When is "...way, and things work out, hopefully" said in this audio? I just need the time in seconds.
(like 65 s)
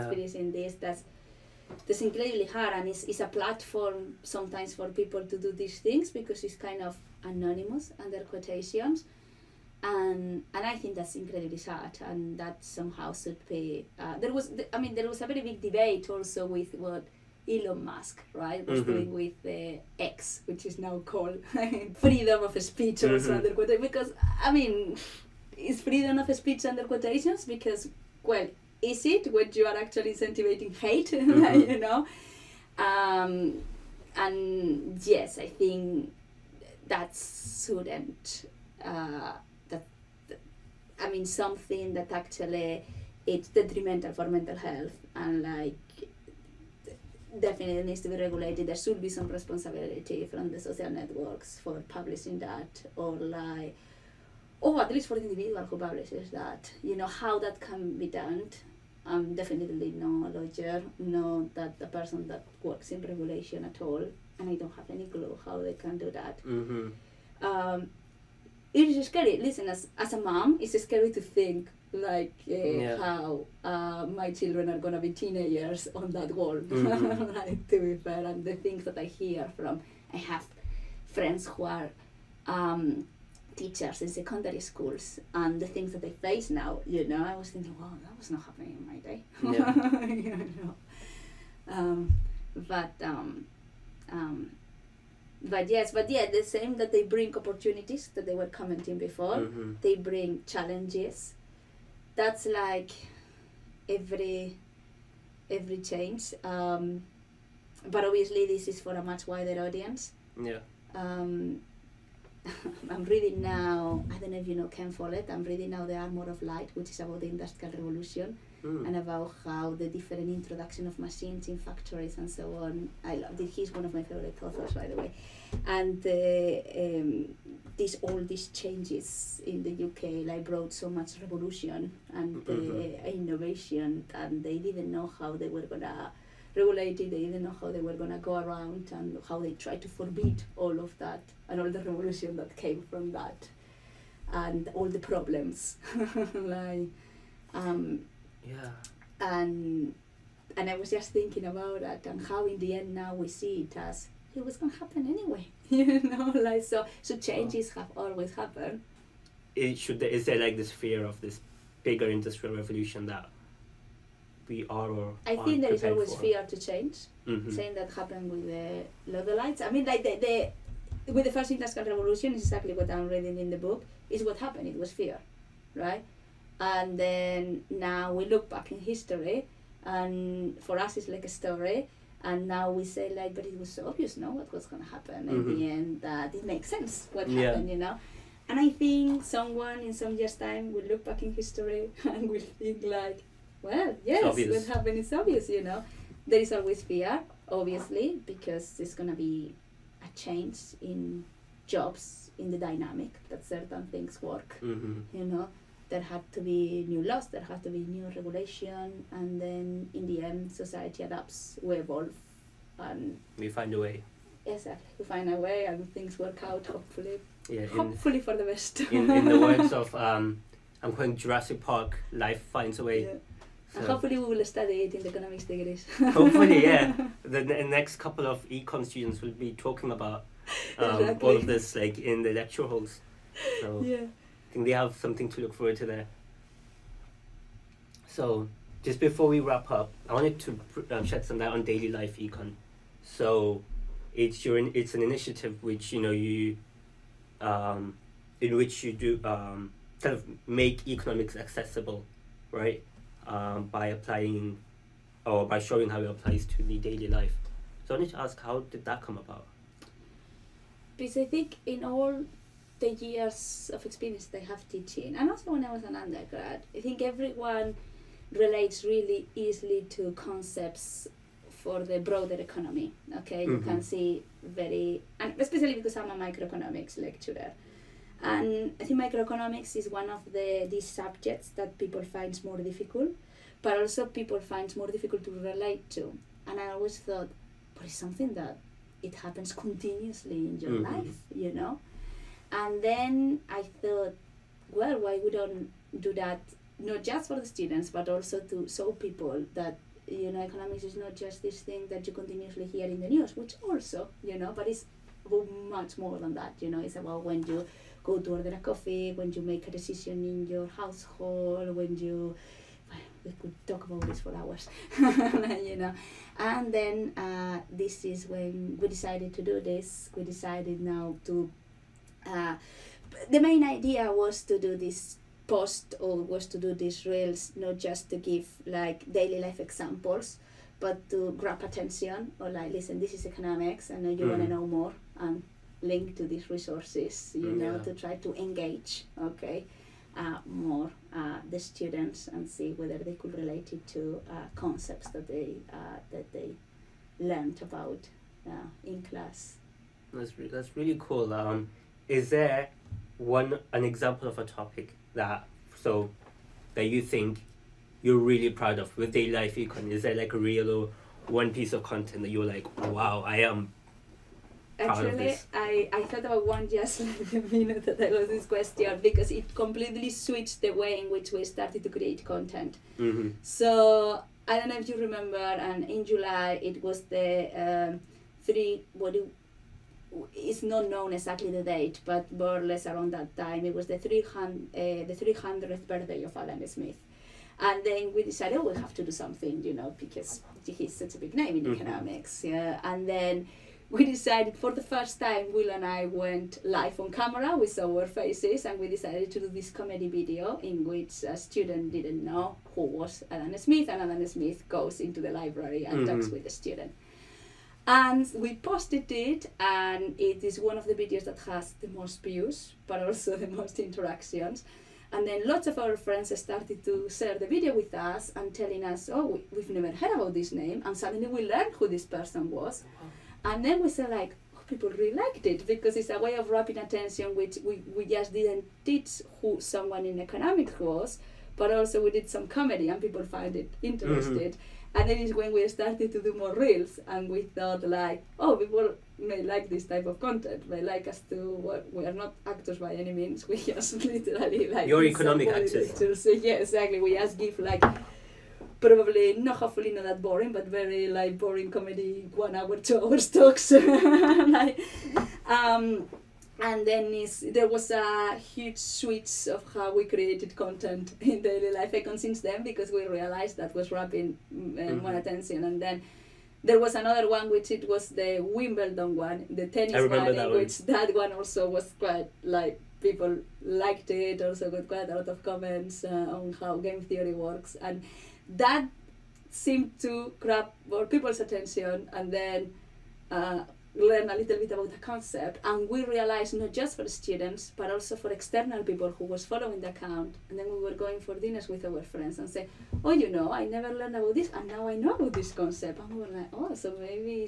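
215 s.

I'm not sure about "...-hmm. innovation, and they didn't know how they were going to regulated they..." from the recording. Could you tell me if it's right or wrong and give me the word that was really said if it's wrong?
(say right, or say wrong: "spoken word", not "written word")
right.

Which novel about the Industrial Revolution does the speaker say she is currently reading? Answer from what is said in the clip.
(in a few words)
The Armor of Light.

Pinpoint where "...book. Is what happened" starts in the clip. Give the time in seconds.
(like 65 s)
173 s.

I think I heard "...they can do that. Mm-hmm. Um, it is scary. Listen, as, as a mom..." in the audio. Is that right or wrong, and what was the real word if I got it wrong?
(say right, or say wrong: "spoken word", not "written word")
right.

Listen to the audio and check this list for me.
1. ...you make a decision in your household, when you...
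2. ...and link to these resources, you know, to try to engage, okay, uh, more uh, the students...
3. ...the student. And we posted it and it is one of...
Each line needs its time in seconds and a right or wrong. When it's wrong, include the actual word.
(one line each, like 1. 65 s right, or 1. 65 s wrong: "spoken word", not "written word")
1. 309 s right
2. 335 s right
3. 406 s right.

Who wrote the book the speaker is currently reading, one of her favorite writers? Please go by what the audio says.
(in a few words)
Ken Follett.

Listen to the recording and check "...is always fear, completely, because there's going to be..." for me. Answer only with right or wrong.
wrong.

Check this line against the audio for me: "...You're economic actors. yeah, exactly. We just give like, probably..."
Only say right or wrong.
right.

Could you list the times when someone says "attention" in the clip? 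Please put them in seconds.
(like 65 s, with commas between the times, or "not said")
331 s, 426 s, 465 s, 481 s.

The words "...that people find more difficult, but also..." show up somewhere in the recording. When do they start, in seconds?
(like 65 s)
281 s.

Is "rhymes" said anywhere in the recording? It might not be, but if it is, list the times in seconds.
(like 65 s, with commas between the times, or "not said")
not said.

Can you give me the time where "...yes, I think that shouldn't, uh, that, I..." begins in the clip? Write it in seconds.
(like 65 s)
35 s.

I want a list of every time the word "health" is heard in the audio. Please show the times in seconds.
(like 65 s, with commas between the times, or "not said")
44 s.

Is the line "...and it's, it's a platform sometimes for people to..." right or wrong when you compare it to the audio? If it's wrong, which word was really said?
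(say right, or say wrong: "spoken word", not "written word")
right.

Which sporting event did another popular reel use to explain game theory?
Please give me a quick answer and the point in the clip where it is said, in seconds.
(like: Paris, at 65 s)
Wimbledon, at 468 s.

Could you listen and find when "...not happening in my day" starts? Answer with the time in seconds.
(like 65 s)
88 s.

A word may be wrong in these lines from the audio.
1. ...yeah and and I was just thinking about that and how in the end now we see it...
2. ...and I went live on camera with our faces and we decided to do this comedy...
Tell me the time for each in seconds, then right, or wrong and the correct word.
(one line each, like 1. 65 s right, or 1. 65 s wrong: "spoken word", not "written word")
1. 148 s right
2. 395 s right.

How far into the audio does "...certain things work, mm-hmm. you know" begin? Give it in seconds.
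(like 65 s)
203 s.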